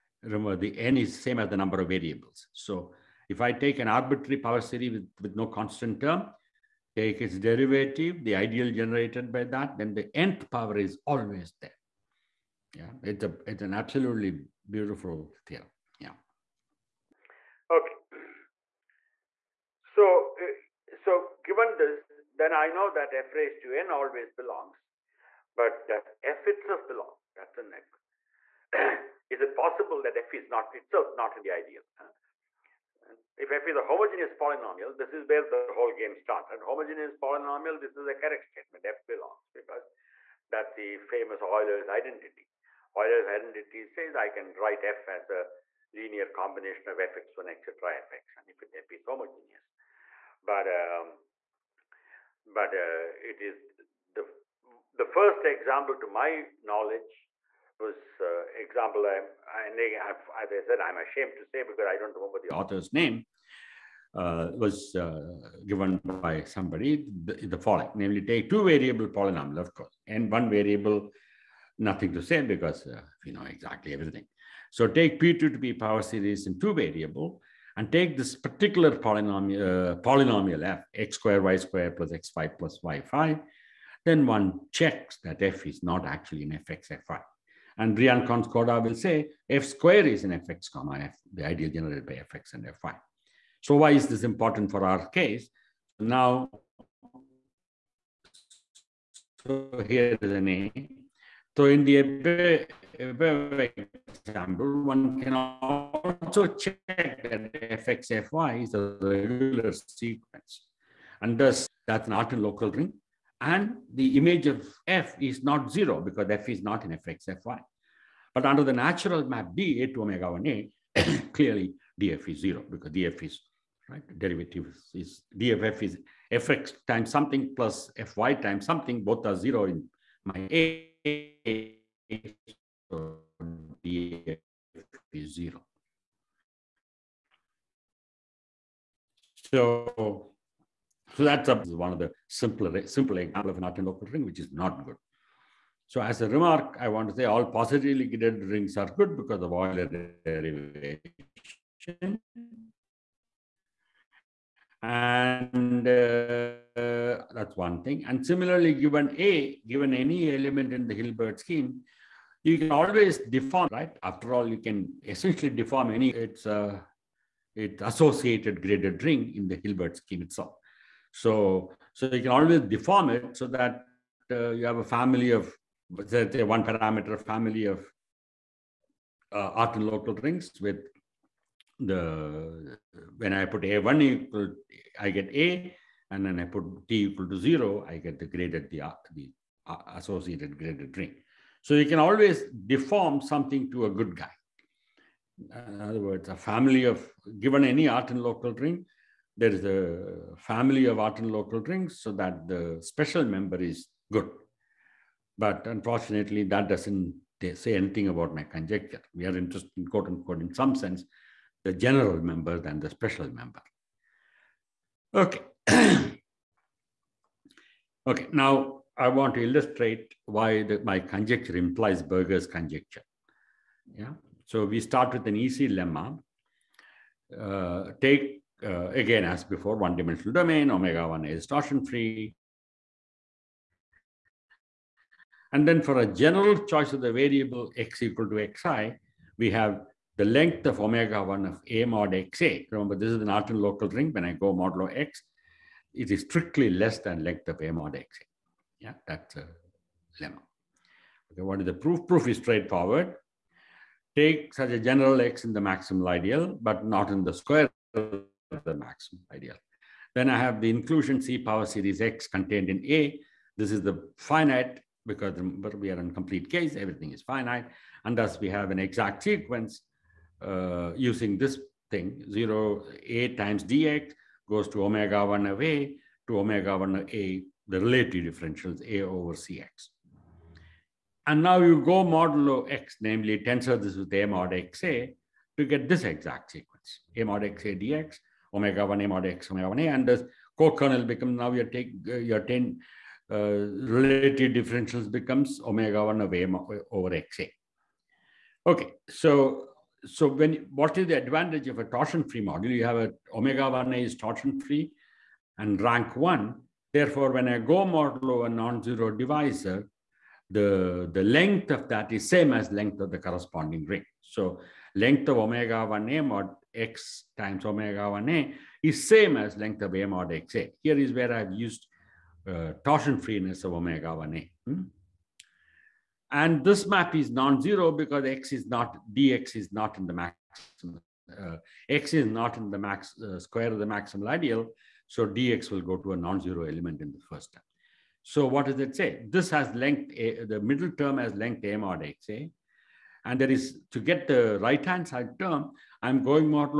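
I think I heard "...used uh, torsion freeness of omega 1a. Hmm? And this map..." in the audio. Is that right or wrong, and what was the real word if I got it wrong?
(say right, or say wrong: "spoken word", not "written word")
right.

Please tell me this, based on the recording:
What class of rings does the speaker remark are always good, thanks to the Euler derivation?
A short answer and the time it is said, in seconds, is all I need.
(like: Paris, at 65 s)
positively graded rings, at 147 s.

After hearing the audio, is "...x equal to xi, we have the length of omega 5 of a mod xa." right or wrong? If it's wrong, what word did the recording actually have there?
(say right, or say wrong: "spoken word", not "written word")
wrong: "1", not "5".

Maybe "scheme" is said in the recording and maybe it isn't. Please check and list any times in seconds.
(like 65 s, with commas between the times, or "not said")
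161 s, 169 s.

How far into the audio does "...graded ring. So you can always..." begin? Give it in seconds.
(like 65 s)
190 s.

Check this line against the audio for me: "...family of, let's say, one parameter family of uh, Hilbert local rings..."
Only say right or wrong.
wrong.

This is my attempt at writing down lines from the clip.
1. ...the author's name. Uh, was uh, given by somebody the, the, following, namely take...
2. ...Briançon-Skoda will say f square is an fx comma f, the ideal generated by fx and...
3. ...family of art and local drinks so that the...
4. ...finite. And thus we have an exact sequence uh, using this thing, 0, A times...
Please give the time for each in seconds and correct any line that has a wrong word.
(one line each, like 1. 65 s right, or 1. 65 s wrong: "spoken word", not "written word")
1. 62 s right
2. 87 s right
3. 200 s right
4. 267 s right.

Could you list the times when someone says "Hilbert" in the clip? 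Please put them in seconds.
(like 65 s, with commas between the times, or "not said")
160 s, 169 s.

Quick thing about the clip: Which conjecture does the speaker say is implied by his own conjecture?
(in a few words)
Berger's conjecture.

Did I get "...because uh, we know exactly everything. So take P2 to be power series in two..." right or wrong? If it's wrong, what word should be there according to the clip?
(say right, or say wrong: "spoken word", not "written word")
right.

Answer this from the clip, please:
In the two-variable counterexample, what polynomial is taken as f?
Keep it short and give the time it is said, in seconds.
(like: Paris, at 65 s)
x^2y^2 + x^5 + y^5, at 80 s.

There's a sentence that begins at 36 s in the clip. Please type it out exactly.
And homogeneous polynomial, this is a correct statement, f belongs, because that's the famous Euler's identity.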